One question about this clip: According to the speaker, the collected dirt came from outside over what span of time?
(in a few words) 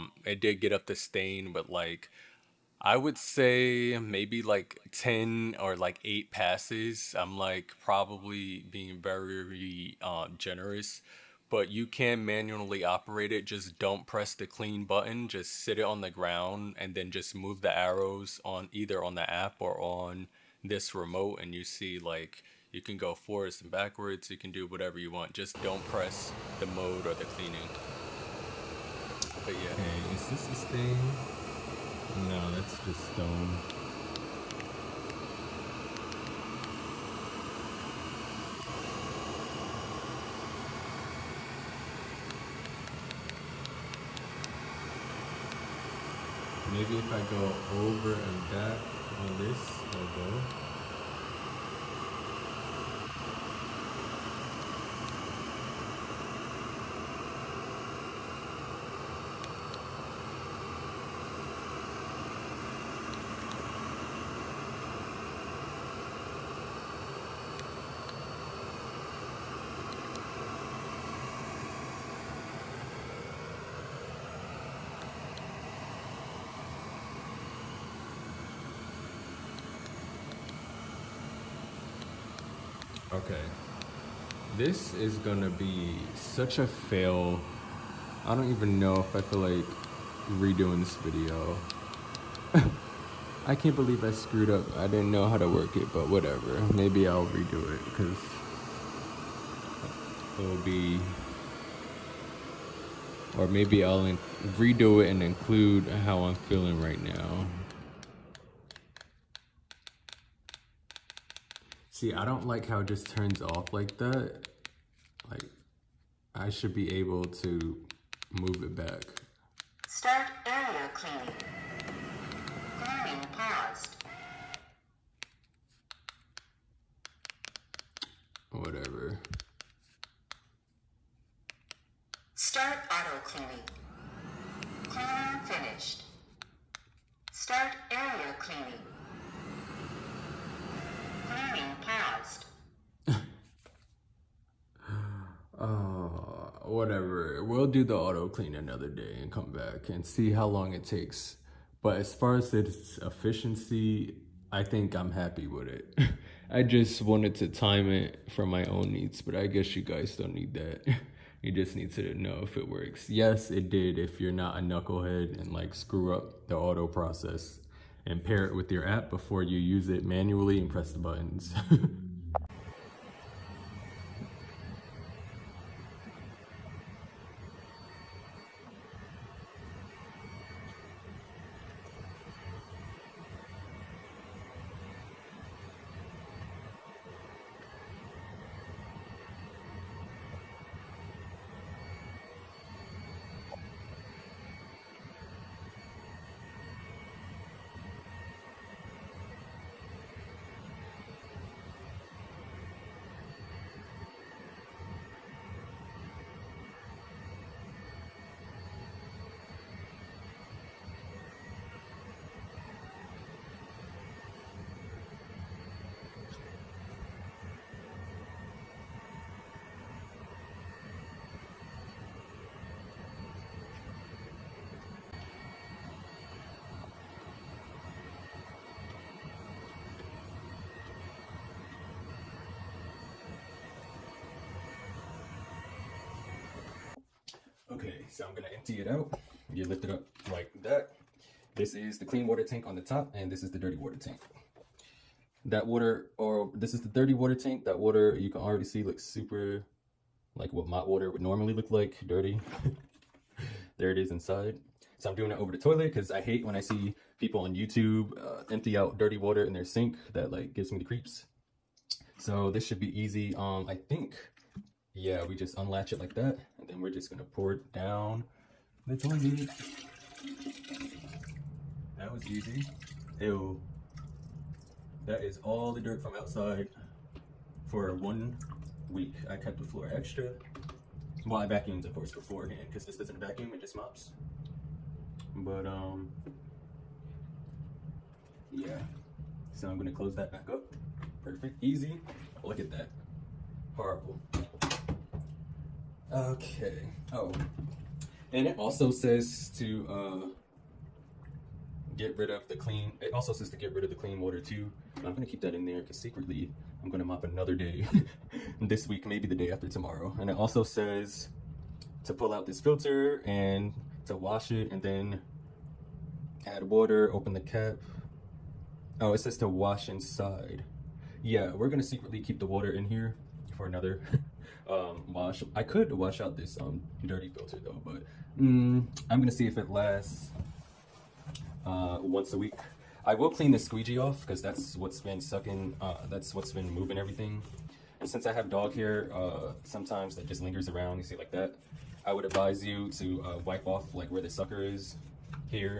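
one week.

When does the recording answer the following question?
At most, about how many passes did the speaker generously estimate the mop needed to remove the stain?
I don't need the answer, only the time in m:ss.
0:04.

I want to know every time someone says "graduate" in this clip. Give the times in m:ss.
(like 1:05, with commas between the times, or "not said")
not said.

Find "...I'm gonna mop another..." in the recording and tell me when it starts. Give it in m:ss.
5:06.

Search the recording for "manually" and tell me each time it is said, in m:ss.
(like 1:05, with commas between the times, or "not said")
0:12, 2:50.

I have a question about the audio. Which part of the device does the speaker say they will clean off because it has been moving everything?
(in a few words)
squeegee.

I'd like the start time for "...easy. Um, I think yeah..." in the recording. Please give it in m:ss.
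4:22.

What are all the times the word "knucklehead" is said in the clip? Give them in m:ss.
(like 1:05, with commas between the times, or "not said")
2:44.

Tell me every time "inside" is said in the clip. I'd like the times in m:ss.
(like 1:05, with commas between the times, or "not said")
4:14, 5:19.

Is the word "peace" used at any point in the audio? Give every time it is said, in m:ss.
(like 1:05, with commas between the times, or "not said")
not said.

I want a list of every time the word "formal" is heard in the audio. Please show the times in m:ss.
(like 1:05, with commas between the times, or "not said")
not said.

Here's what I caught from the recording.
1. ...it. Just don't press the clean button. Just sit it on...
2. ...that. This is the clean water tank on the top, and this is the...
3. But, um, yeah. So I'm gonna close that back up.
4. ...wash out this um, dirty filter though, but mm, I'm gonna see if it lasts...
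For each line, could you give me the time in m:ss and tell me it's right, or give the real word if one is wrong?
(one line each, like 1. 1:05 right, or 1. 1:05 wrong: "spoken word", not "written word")
1. 0:13 right
2. 4:00 right
3. 4:45 right
4. 5:25 right.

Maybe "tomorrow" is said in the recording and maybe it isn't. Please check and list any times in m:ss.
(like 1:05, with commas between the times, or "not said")
5:09.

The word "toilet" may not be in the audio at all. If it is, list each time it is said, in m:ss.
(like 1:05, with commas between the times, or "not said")
4:15, 4:28.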